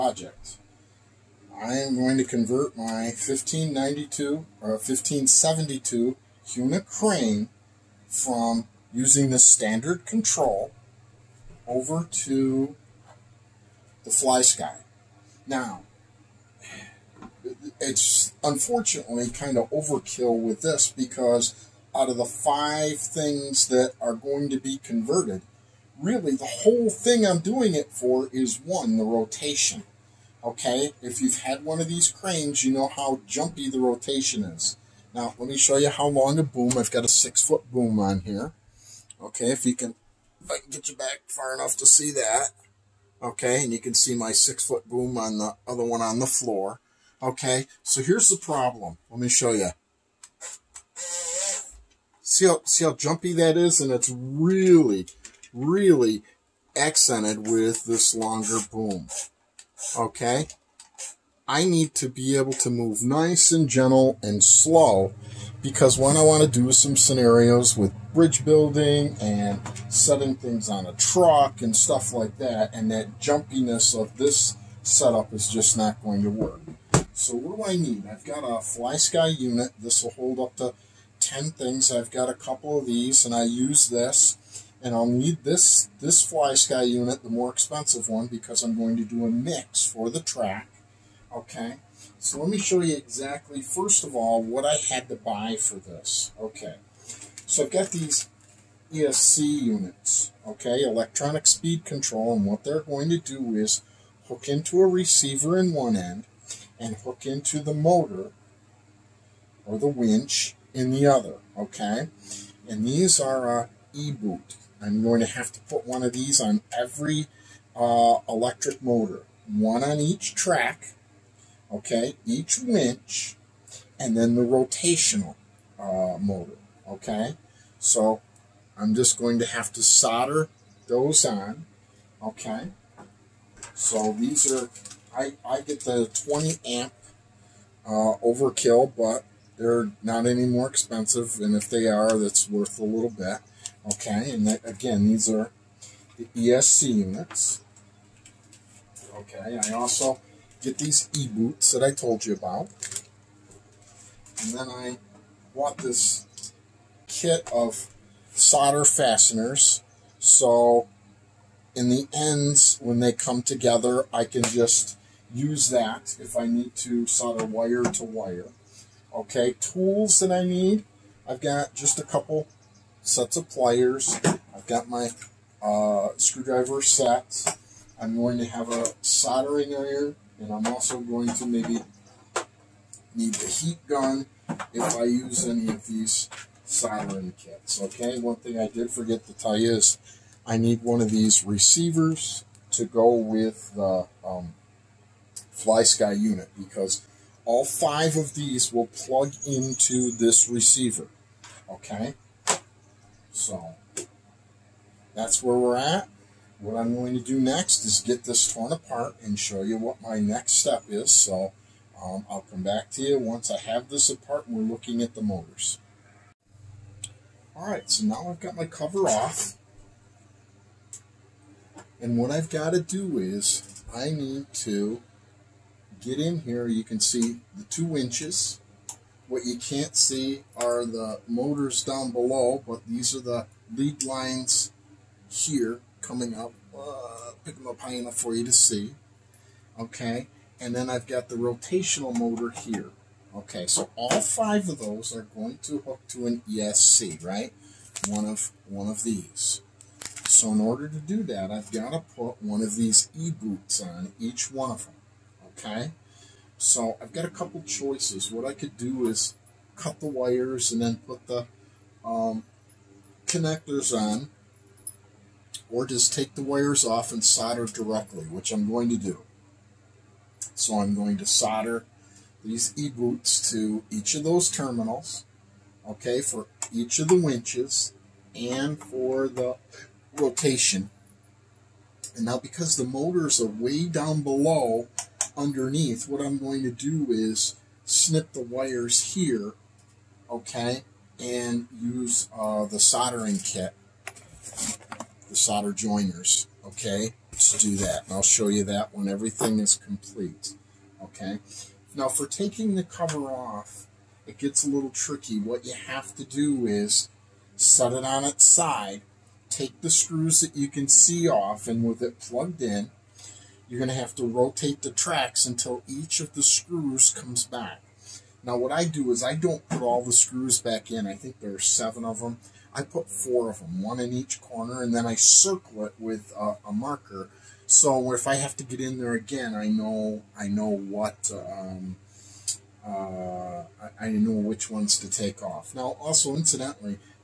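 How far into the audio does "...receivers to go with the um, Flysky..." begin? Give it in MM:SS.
03:11.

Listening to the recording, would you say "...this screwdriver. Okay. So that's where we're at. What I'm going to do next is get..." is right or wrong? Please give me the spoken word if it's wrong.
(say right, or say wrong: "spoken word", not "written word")
wrong: "receiver", not "screwdriver".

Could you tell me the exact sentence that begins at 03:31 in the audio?
So um, I'll come back to you once I have this apart and we're looking at the motors.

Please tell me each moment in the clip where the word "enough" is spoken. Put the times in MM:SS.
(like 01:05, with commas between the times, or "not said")
00:41, 03:57.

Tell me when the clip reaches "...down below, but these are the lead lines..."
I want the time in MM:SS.
03:51.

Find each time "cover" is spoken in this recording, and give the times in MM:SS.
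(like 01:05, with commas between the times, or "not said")
03:38, 05:02.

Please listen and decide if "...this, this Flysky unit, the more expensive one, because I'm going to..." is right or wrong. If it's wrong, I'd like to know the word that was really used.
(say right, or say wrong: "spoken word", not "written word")
right.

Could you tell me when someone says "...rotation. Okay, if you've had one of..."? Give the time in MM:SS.
00:29.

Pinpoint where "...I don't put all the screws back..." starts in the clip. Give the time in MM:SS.
05:19.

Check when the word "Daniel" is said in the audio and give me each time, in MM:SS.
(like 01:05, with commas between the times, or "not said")
not said.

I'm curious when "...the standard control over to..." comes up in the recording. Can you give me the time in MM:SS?
00:09.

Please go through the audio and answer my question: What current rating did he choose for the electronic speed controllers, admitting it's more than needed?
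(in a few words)
20 amp.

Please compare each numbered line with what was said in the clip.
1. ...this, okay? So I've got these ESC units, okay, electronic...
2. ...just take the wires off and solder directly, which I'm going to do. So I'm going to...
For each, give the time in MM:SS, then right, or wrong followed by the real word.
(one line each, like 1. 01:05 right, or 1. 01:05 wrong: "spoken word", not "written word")
1. 01:35 right
2. 04:25 right.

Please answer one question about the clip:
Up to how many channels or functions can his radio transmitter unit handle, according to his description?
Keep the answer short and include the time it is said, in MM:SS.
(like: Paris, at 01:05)
10, at 01:21.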